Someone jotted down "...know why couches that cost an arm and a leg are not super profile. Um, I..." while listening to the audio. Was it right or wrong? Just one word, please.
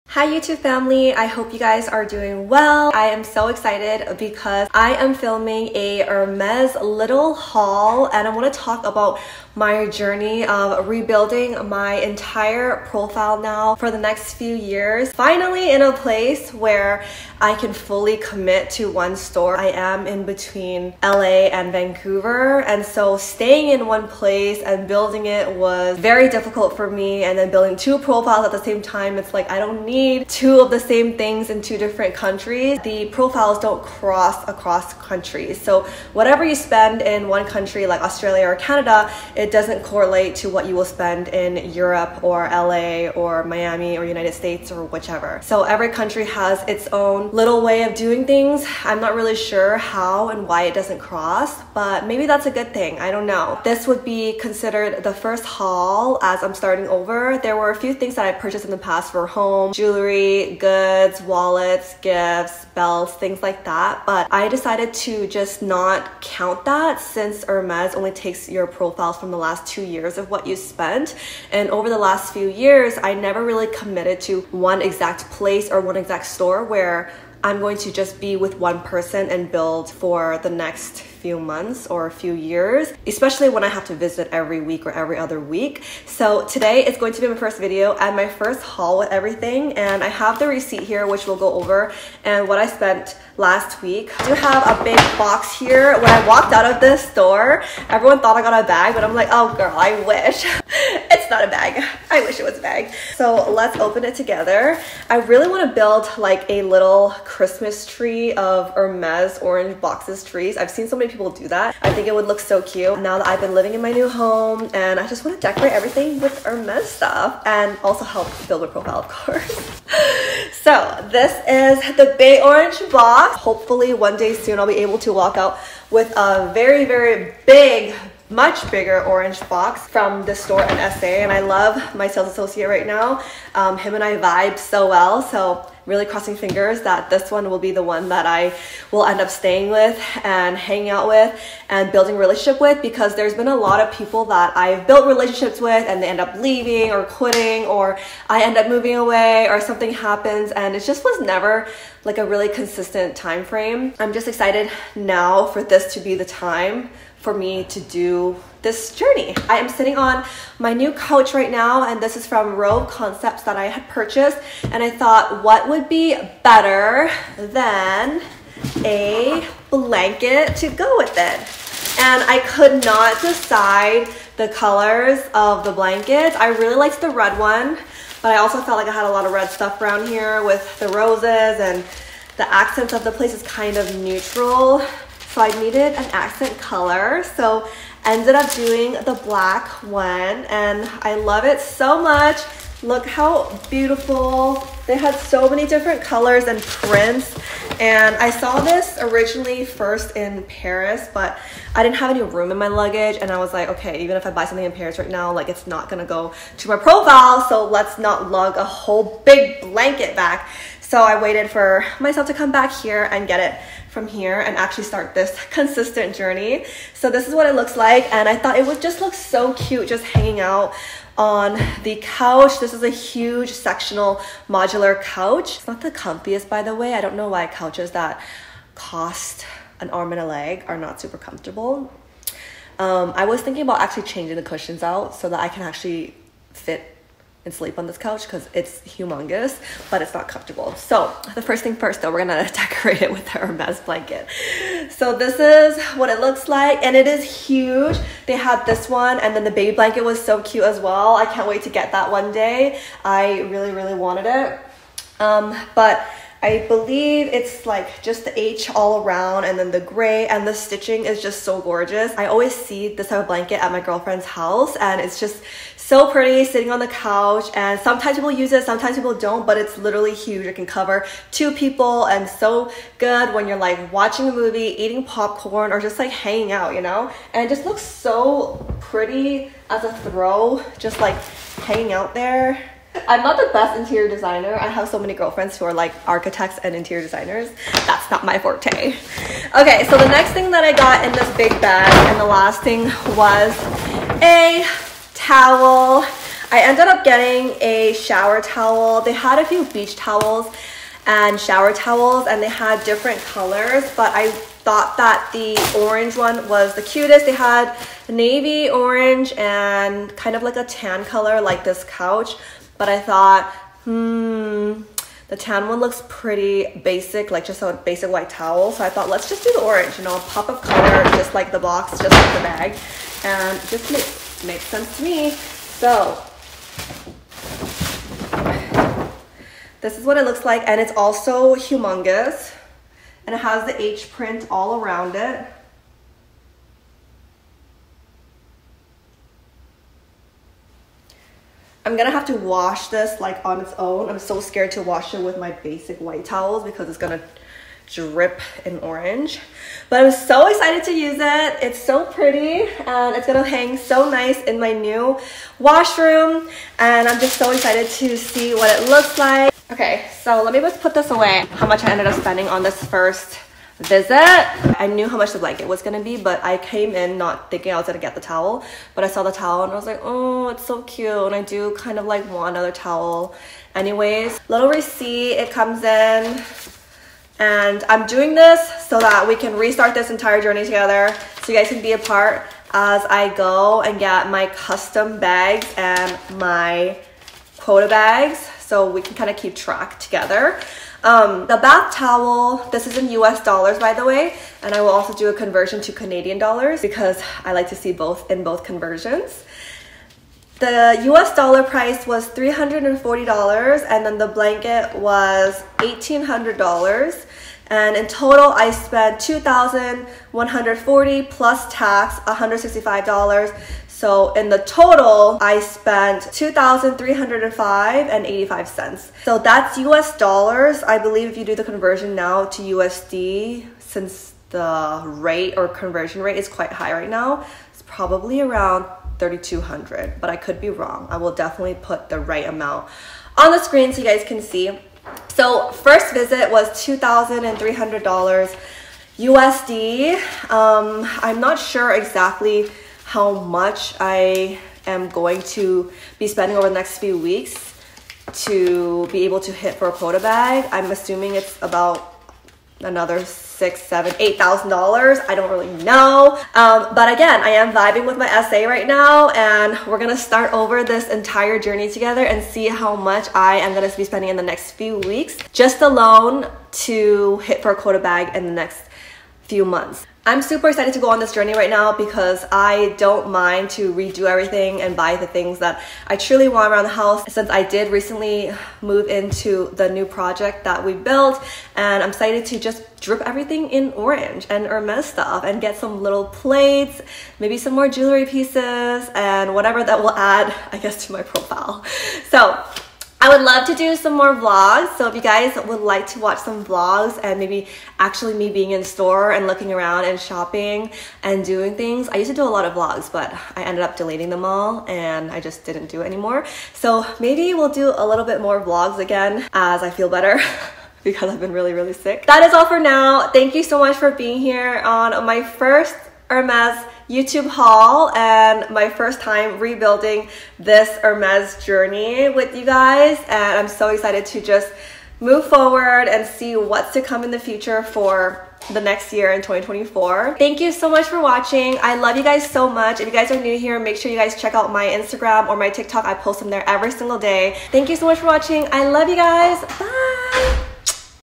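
wrong.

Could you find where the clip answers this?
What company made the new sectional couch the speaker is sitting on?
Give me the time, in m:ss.
2:42.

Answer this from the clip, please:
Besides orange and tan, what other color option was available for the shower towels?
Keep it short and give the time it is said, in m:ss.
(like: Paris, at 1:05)
Navy, at 5:08.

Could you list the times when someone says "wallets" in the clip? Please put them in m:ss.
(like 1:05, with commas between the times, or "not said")
1:01.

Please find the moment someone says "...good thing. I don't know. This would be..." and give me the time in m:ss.
0:52.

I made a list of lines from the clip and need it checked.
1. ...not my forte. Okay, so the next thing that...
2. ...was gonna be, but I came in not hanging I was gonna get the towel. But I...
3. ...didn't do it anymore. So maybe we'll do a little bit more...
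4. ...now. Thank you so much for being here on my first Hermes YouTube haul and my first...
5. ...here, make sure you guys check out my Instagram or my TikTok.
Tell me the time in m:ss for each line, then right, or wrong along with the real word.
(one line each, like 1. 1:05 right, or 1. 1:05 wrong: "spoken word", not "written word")
1. 4:48 right
2. 6:05 wrong: "thinking", not "hanging"
3. 8:25 right
4. 8:32 right
5. 8:53 right.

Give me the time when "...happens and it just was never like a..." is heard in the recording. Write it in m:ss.
2:29.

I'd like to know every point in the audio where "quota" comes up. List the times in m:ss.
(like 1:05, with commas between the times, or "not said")
6:27, 7:29, 7:47.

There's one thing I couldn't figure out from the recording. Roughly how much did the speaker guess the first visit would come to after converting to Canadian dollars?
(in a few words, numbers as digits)
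3,200.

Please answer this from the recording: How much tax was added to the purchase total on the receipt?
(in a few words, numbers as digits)
$165.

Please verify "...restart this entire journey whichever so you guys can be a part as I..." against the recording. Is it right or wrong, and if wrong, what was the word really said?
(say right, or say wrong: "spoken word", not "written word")
wrong: "together", not "whichever".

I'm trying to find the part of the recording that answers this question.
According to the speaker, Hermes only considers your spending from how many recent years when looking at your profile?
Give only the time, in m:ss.
1:09.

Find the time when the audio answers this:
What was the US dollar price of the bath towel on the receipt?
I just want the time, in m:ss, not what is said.
6:42.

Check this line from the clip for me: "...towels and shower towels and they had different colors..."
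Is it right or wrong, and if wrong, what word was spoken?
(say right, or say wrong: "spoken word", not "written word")
right.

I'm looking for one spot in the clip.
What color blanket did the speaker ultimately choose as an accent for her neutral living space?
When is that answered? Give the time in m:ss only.
3:09.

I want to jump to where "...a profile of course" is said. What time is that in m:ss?
1:58.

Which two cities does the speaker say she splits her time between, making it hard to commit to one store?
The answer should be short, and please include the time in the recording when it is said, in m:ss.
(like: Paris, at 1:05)
LA and Vancouver, at 0:21.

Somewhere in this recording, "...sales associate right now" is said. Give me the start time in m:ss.
2:12.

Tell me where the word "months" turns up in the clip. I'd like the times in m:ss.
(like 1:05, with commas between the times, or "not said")
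1:21, 7:49.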